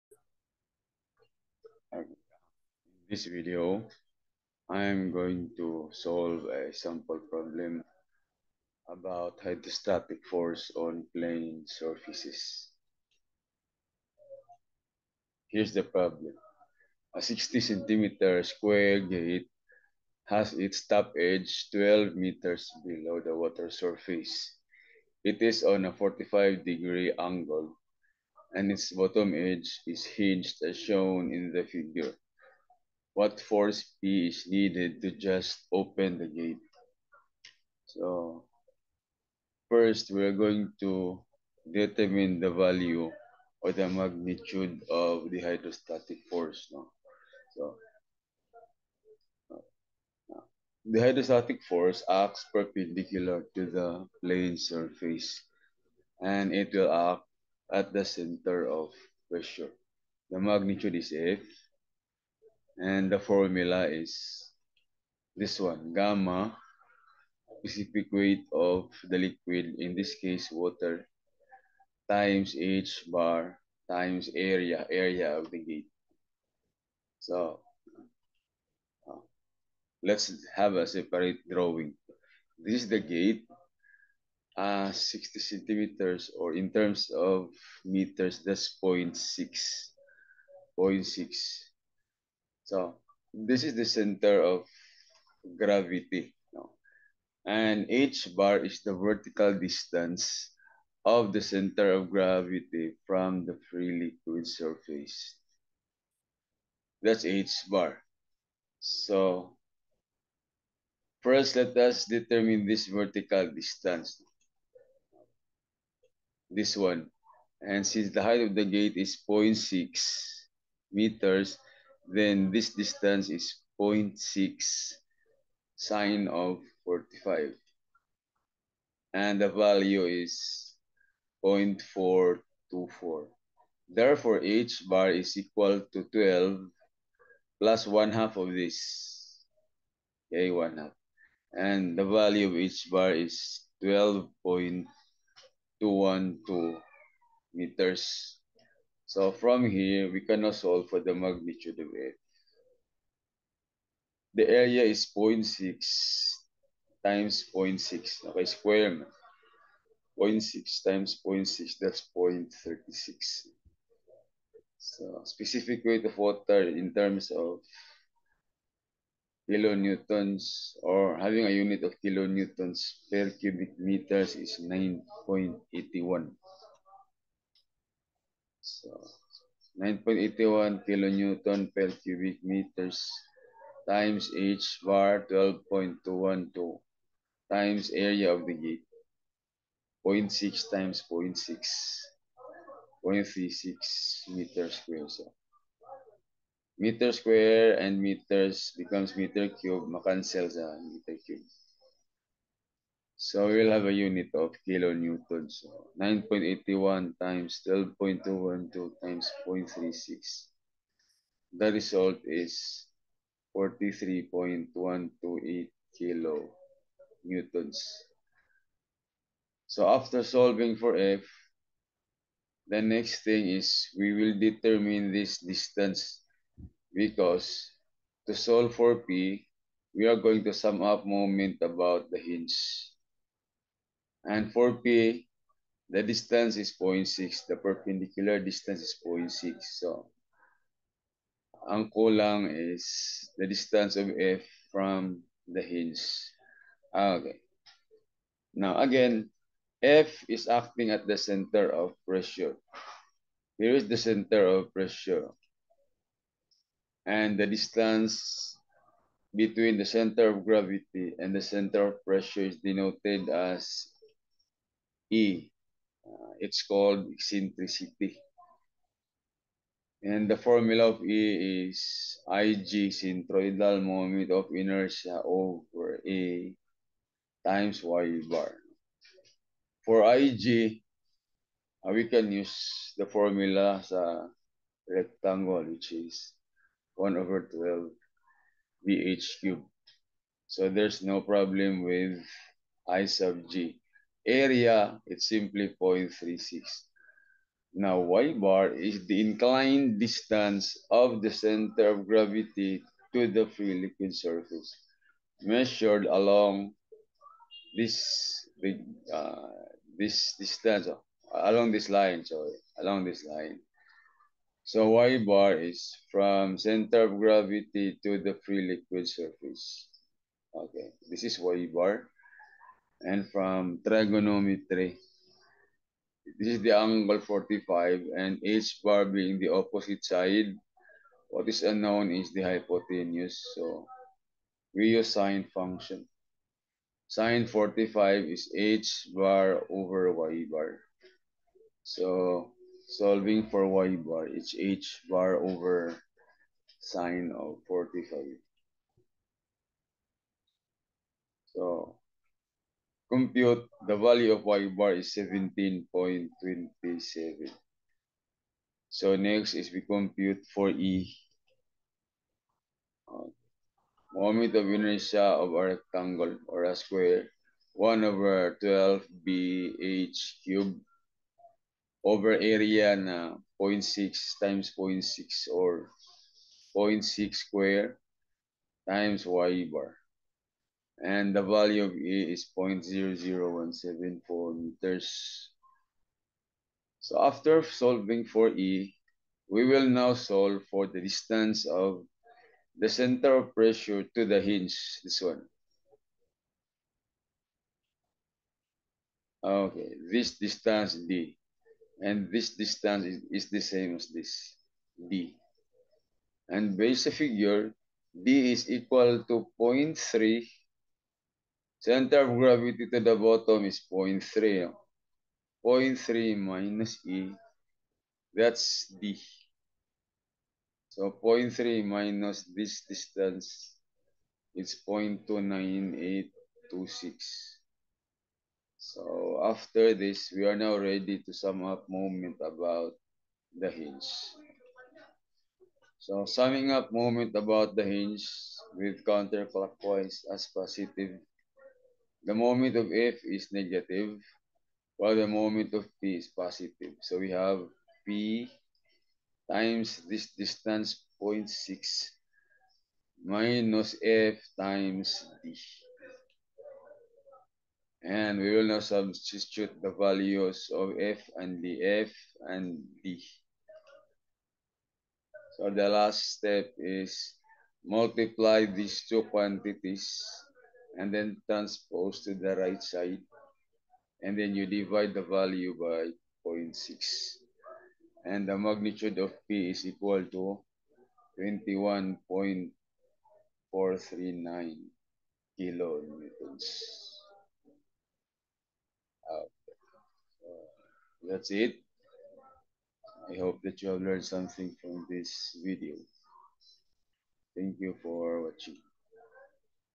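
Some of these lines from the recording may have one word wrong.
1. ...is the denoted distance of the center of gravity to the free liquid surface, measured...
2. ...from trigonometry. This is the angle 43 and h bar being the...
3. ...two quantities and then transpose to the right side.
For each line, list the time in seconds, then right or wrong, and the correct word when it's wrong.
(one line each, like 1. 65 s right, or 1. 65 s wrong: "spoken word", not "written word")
1. 298 s wrong: "inclined", not "denoted"
2. 323 s wrong: "45", not "43"
3. 469 s right.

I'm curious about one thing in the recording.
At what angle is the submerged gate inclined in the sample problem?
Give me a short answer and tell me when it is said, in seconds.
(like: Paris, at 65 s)
45 degrees, at 25 s.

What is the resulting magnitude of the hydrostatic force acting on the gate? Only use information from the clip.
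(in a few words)
43.128 kilonewtons.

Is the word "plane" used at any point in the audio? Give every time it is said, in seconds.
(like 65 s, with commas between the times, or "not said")
11 s, 54 s.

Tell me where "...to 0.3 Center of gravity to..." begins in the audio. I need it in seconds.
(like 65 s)
409 s.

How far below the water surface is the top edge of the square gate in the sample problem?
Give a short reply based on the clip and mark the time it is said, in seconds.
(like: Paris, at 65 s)
12 meters, at 21 s.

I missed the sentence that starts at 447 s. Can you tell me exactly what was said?
So we have P times this distance 0.6 minus F times D.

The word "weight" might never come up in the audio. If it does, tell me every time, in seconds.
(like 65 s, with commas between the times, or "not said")
68 s, 165 s.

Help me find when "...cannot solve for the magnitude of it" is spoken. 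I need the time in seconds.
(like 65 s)
150 s.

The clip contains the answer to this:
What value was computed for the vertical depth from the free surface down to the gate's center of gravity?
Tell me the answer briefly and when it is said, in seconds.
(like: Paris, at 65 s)
12.212 meters, at 143 s.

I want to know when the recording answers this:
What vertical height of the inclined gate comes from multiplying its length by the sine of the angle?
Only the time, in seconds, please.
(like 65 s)
131 s.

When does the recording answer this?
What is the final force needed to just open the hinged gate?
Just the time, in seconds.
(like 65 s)
481 s.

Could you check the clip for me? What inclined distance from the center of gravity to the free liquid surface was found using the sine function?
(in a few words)
17.27.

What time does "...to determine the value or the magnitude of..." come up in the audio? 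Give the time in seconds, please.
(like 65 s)
40 s.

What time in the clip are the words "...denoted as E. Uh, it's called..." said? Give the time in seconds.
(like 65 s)
262 s.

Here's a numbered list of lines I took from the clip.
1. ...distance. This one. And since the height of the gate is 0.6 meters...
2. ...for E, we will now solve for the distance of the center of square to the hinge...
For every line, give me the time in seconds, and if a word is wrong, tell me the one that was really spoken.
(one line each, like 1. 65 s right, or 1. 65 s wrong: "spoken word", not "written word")
1. 113 s right
2. 388 s wrong: "pressure", not "square".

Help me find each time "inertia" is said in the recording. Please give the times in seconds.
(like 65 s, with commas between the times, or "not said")
274 s, 364 s.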